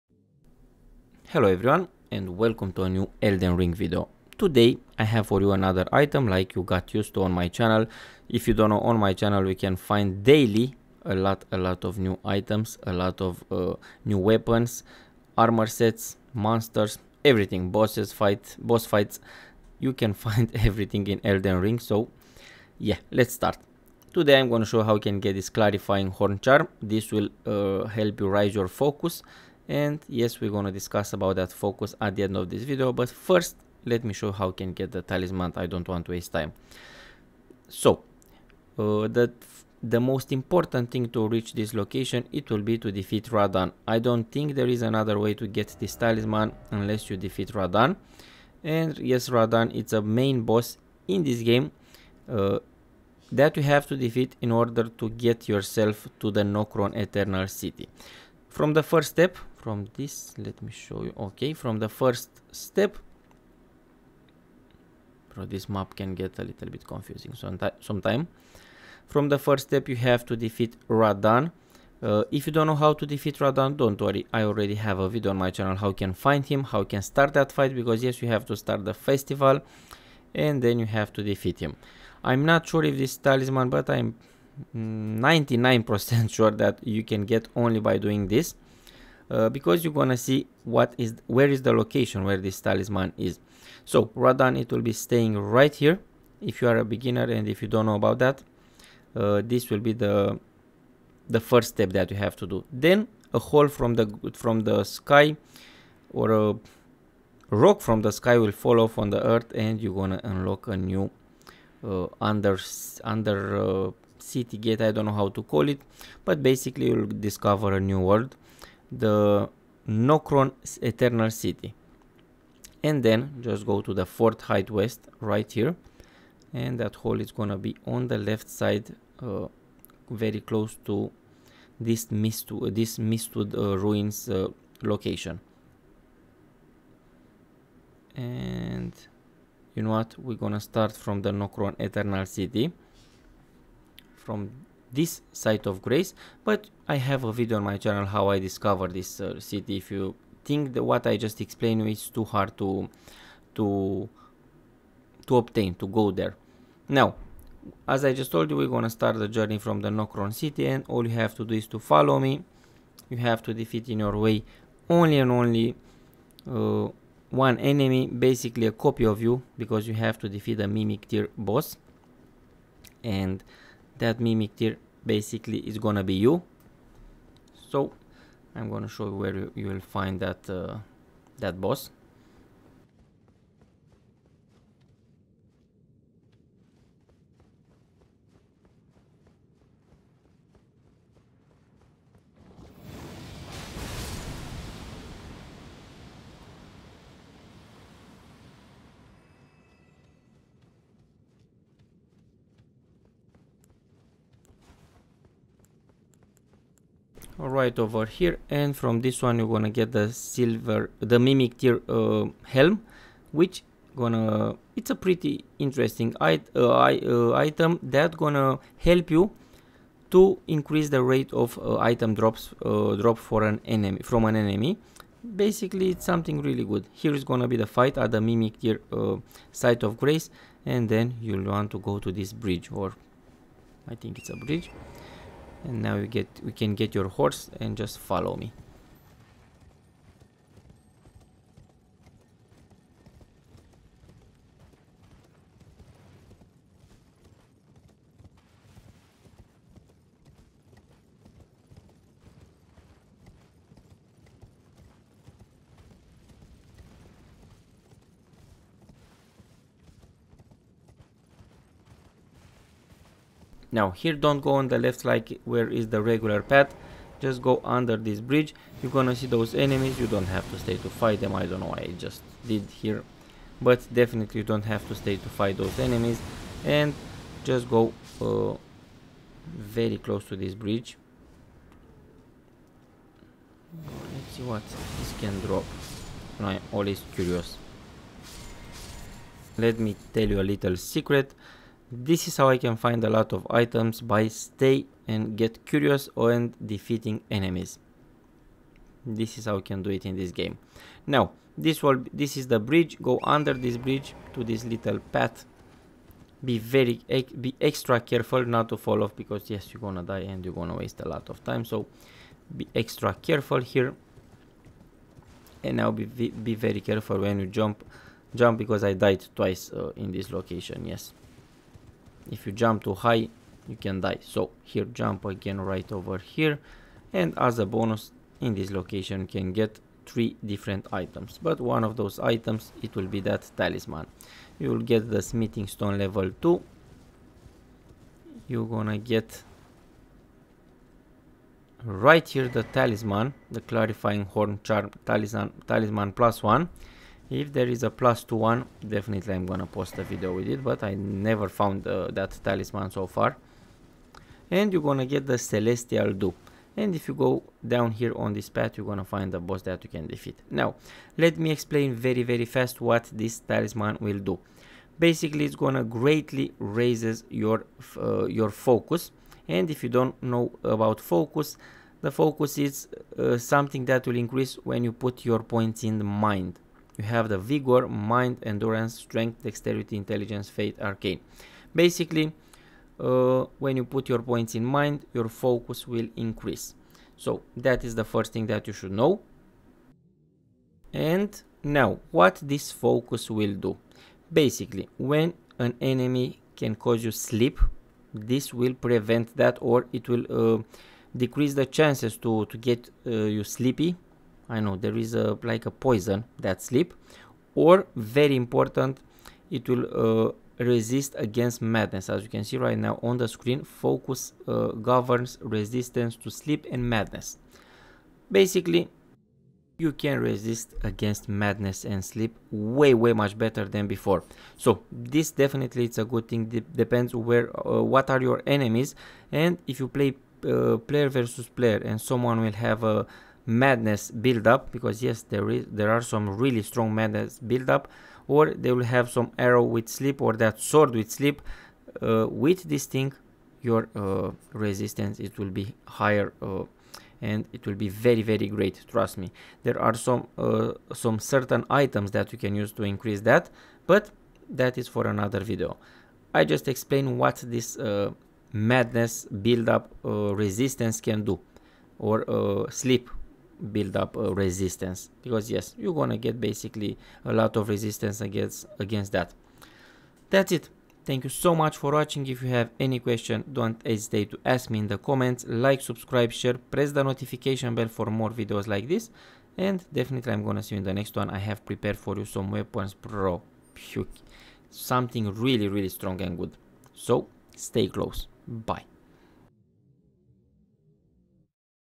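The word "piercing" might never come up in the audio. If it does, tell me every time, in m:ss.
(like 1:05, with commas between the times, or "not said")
not said.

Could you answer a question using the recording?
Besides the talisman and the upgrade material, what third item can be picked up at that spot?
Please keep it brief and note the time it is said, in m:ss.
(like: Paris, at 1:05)
Celestial Dew, at 5:55.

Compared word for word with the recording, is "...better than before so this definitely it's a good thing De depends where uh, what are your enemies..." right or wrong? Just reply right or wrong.
right.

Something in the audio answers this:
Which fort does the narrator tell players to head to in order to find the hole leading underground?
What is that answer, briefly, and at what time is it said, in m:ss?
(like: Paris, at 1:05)
Fort Haight West, at 2:04.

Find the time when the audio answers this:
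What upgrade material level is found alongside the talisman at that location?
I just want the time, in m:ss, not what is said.
5:35.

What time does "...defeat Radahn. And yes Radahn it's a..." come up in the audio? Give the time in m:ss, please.
0:47.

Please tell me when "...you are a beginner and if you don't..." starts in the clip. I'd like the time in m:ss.
1:36.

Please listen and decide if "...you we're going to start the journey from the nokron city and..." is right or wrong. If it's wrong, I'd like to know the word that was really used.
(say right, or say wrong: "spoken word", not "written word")
right.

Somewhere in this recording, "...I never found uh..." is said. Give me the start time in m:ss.
5:50.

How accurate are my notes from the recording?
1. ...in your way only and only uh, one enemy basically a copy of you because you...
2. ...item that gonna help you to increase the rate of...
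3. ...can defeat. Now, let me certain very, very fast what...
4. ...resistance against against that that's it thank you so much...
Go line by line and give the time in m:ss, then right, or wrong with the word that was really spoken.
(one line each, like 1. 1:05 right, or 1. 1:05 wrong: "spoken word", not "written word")
1. 2:43 right
2. 3:37 right
3. 5:59 wrong: "explain", not "certain"
4. 7:47 right.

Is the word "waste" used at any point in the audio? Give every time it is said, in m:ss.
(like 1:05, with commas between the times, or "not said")
0:36, 5:10.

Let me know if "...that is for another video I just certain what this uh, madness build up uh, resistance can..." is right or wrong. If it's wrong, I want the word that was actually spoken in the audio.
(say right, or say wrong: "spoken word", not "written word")
wrong: "explain", not "certain".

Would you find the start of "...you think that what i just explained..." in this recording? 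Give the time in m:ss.
2:29.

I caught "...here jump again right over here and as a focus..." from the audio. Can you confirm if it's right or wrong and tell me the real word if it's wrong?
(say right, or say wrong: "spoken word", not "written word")
wrong: "bonus", not "focus".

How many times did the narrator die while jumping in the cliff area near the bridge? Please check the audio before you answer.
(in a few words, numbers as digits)
twice.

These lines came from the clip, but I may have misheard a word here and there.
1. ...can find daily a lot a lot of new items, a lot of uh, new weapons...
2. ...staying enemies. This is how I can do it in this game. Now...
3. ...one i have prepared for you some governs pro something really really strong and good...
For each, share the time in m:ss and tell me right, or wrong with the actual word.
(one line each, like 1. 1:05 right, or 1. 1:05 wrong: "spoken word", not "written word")
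1. 0:09 right
2. 4:56 wrong: "defeating", not "staying"
3. 8:01 wrong: "weapons", not "governs".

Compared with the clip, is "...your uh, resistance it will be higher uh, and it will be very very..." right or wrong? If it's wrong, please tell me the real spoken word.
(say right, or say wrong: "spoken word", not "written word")
right.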